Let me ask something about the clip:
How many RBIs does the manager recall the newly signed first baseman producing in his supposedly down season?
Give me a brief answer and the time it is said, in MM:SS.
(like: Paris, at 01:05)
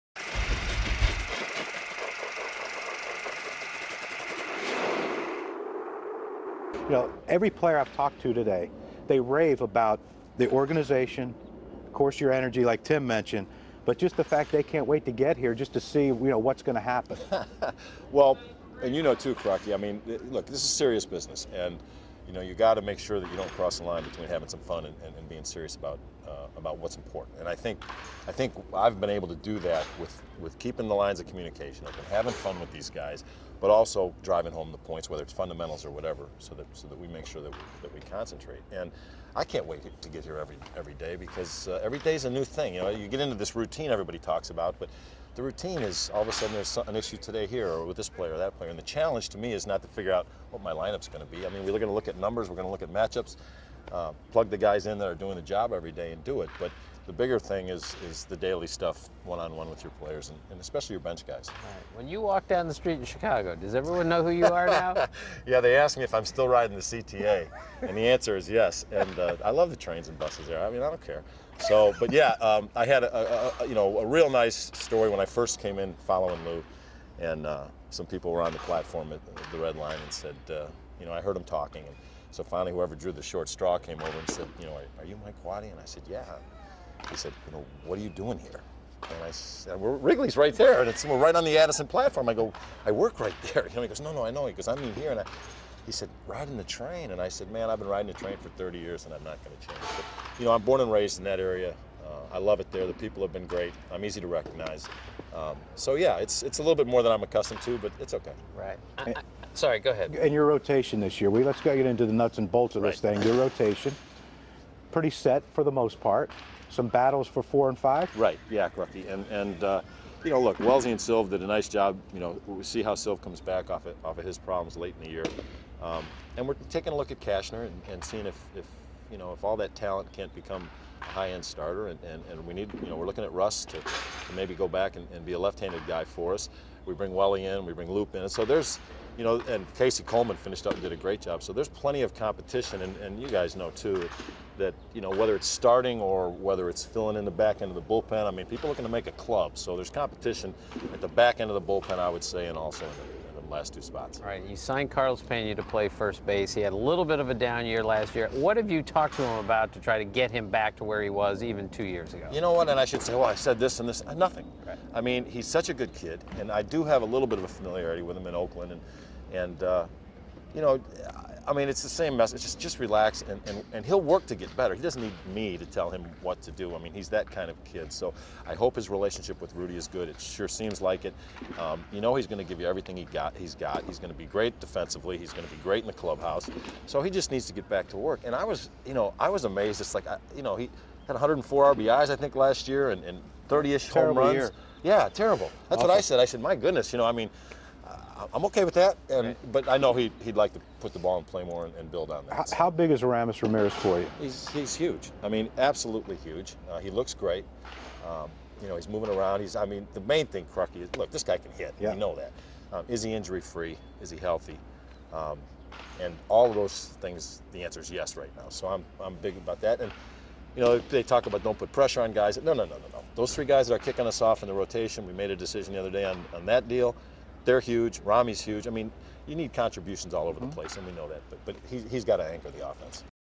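104, at 03:11.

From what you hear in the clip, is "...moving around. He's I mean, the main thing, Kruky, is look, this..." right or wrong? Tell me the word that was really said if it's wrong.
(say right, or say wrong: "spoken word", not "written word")
right.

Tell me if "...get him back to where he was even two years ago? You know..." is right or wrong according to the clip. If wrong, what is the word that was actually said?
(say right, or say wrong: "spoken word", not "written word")
right.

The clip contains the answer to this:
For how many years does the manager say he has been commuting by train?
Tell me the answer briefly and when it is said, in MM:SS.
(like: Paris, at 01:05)
30, at 01:38.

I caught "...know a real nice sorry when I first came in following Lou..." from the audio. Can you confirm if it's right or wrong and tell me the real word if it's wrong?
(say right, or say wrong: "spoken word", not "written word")
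wrong: "story", not "sorry".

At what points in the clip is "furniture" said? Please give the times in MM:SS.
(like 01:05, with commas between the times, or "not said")
not said.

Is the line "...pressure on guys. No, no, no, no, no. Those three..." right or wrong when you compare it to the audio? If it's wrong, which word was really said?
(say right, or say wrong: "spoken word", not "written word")
right.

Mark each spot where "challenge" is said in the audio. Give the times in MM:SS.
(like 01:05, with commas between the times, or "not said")
00:48.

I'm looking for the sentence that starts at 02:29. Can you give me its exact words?
So there's competition at the back end of the bullpen, I would say, and also in the, in the last two spots.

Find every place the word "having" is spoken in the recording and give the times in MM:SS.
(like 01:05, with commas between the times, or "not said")
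00:24, 00:32.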